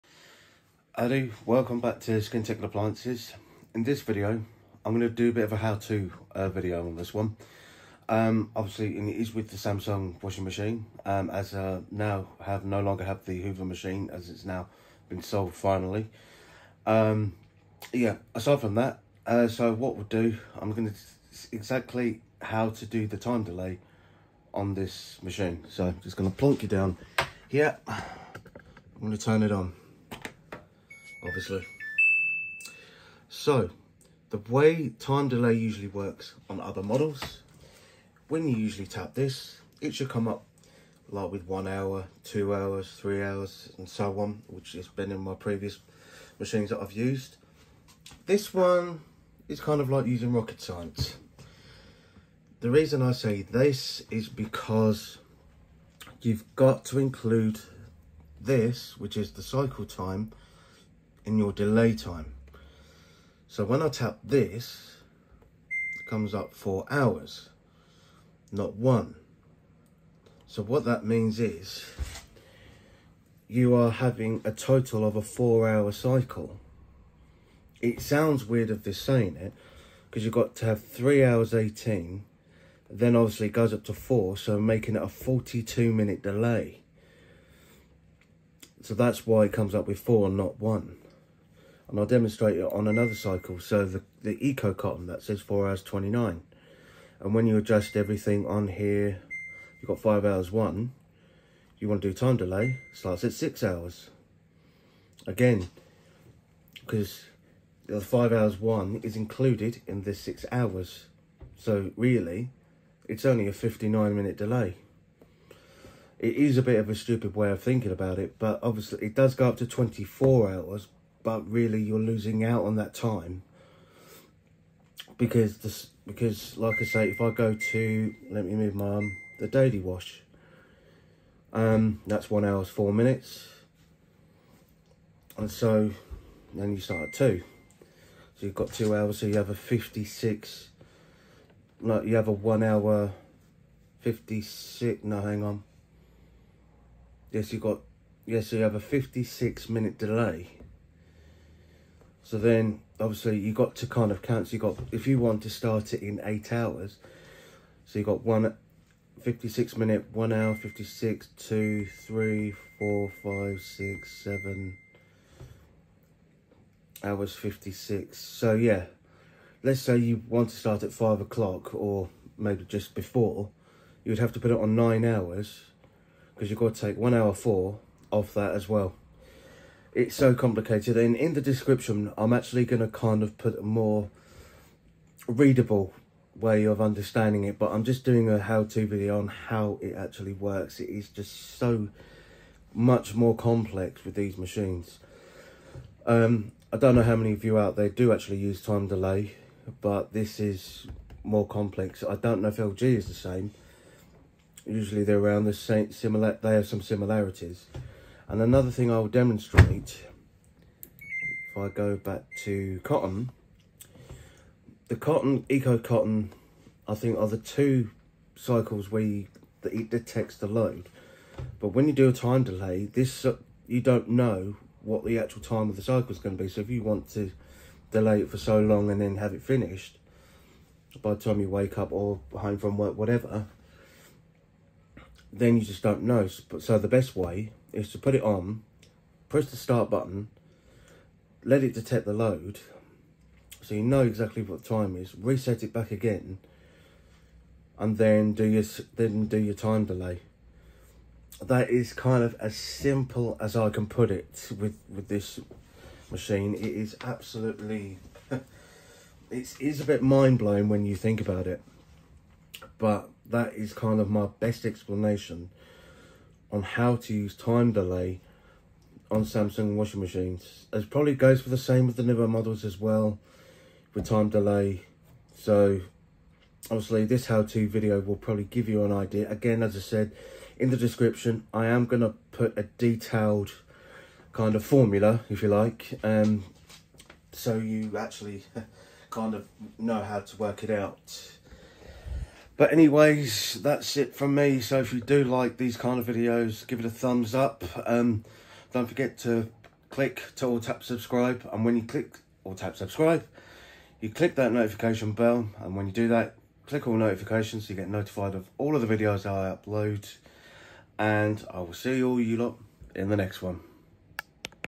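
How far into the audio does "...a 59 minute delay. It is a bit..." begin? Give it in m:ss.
1:53.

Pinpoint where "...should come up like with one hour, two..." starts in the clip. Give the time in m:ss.
0:39.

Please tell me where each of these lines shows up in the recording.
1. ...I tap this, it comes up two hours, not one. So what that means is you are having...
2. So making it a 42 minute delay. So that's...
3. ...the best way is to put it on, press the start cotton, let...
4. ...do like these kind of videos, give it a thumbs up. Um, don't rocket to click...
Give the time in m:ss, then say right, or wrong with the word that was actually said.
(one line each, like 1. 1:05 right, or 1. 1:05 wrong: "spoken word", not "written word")
1. 1:03 wrong: "four", not "two"
2. 1:24 right
3. 3:56 wrong: "button", not "cotton"
4. 4:55 wrong: "forget", not "rocket".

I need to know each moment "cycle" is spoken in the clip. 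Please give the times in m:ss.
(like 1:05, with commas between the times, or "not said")
0:59, 1:15, 1:33, 3:38, 3:45.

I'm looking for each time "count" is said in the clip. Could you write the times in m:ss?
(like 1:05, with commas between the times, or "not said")
2:34.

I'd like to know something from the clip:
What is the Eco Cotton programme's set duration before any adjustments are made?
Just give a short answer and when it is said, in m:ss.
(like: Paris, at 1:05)
4 hours 29, at 1:35.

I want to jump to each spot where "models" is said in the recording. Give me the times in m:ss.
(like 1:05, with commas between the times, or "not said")
0:36, 4:32.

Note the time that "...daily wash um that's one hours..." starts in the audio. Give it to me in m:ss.
2:09.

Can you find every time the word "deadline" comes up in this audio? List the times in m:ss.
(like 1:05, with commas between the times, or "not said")
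not said.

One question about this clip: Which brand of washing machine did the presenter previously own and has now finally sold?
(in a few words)
Hoover.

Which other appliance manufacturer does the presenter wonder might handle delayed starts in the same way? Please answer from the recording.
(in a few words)
LG.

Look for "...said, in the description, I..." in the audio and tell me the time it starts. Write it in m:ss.
4:39.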